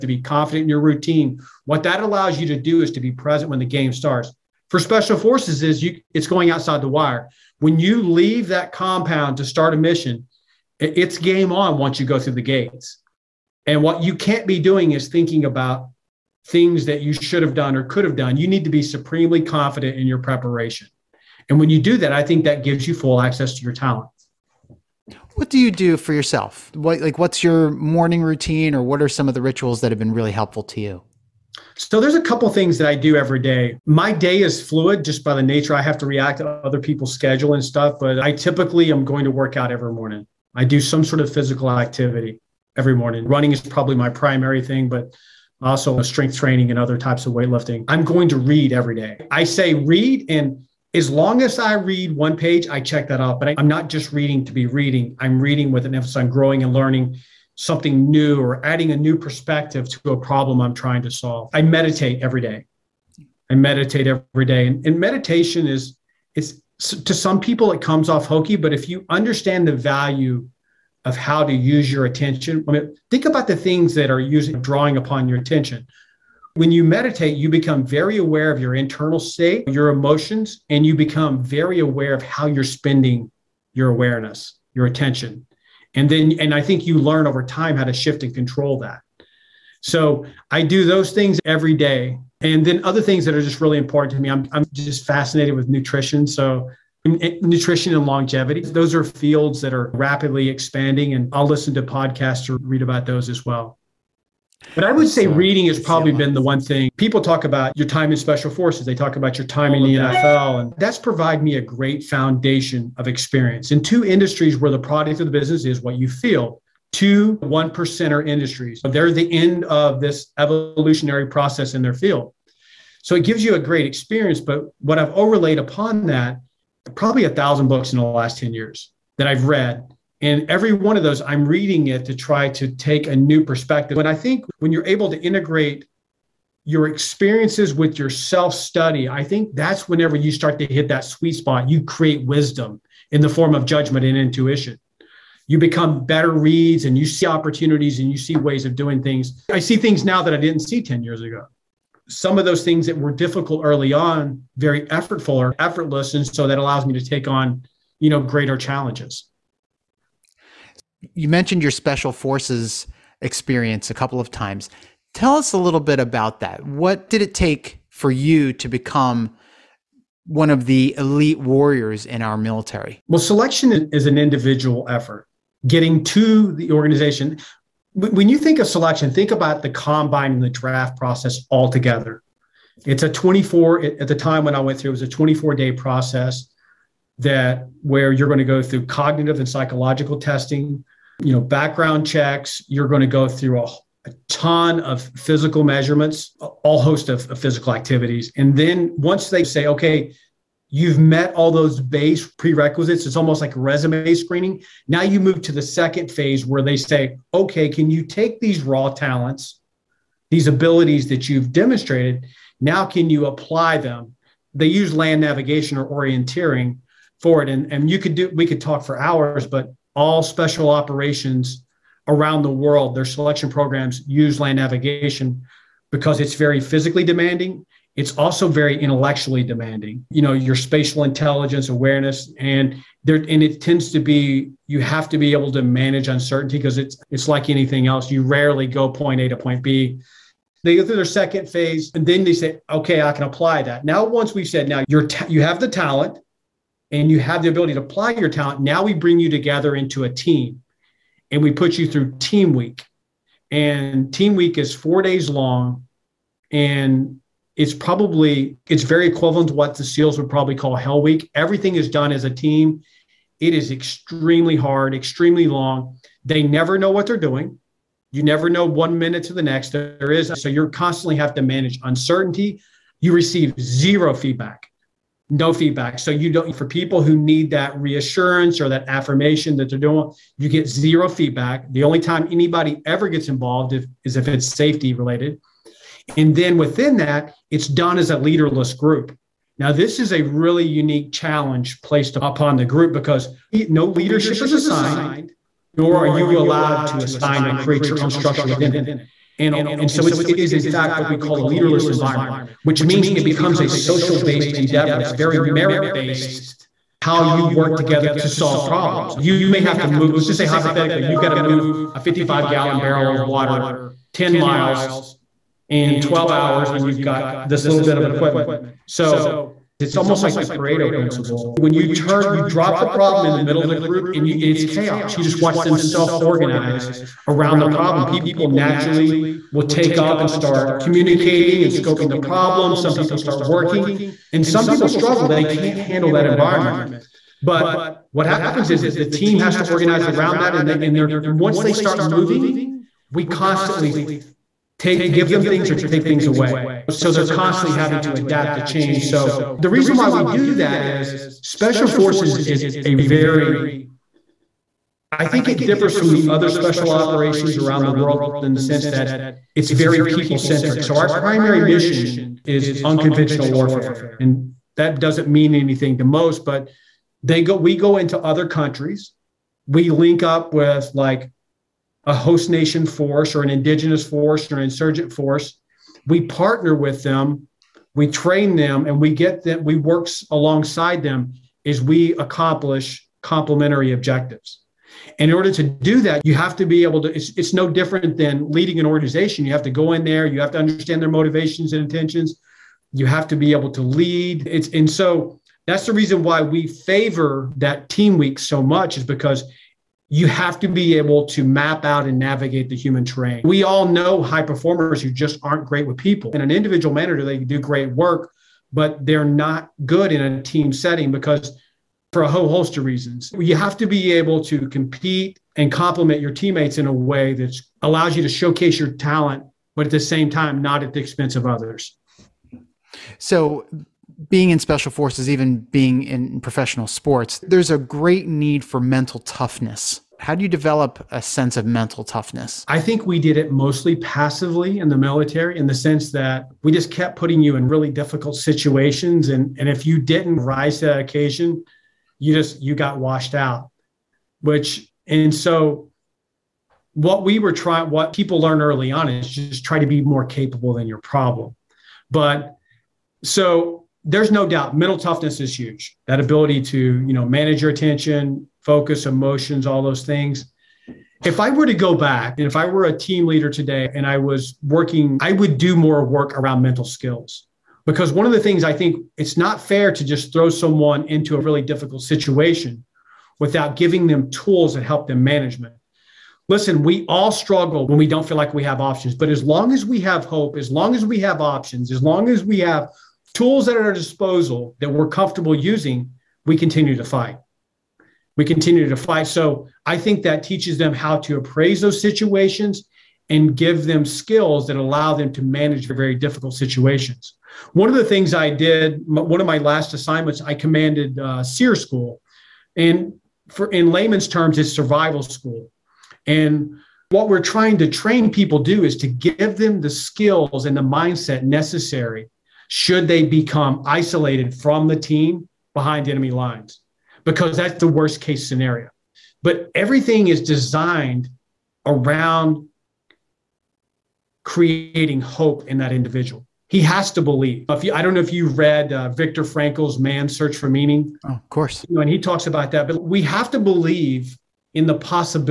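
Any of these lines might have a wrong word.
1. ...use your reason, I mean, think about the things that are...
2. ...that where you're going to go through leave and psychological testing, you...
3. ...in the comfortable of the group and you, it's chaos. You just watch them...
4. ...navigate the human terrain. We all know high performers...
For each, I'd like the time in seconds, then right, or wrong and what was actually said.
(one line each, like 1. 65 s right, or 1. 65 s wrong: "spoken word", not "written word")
1. 71 s wrong: "attention", not "reason"
2. 187 s wrong: "cognitive", not "leave"
3. 323 s wrong: "middle", not "comfortable"
4. 402 s right.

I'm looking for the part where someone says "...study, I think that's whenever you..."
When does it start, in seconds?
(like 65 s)
138 s.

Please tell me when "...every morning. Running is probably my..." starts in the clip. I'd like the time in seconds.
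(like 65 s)
42 s.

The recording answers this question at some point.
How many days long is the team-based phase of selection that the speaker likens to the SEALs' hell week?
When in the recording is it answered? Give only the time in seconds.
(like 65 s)
254 s.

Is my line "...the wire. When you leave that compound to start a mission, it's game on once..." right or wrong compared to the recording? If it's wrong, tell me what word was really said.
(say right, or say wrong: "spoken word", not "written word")
right.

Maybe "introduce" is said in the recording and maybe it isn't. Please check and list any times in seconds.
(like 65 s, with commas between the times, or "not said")
not said.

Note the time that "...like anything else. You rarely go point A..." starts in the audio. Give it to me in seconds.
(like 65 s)
237 s.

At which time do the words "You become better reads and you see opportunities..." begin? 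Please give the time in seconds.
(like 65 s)
145 s.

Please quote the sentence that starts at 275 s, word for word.
So you don't for people who need that reassurance or that affirmation that they're doing, you get zero feedback.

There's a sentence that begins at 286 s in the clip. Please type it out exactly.
And then within that, it's done as a leaderless group.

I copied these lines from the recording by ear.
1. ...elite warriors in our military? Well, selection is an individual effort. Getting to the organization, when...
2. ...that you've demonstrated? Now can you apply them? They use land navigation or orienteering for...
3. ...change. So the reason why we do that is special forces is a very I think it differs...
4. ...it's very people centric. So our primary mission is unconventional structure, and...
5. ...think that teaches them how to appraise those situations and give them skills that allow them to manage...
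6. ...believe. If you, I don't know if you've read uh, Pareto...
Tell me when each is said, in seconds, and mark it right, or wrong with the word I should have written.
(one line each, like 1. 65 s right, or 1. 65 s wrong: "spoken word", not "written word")
1. 170 s right
2. 211 s right
3. 348 s right
4. 359 s wrong: "warfare", not "structure"
5. 489 s right
6. 527 s wrong: "Viktor", not "Pareto".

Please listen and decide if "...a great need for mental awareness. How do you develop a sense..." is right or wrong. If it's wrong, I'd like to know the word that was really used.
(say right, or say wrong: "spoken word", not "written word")
wrong: "toughness", not "awareness".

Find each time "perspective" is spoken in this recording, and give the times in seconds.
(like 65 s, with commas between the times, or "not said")
59 s, 133 s.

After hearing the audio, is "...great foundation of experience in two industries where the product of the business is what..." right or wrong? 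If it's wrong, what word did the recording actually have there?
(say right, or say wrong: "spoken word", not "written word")
right.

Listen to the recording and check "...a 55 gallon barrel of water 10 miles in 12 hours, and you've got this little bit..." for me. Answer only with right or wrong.
right.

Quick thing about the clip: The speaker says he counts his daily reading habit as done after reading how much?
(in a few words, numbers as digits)
one page.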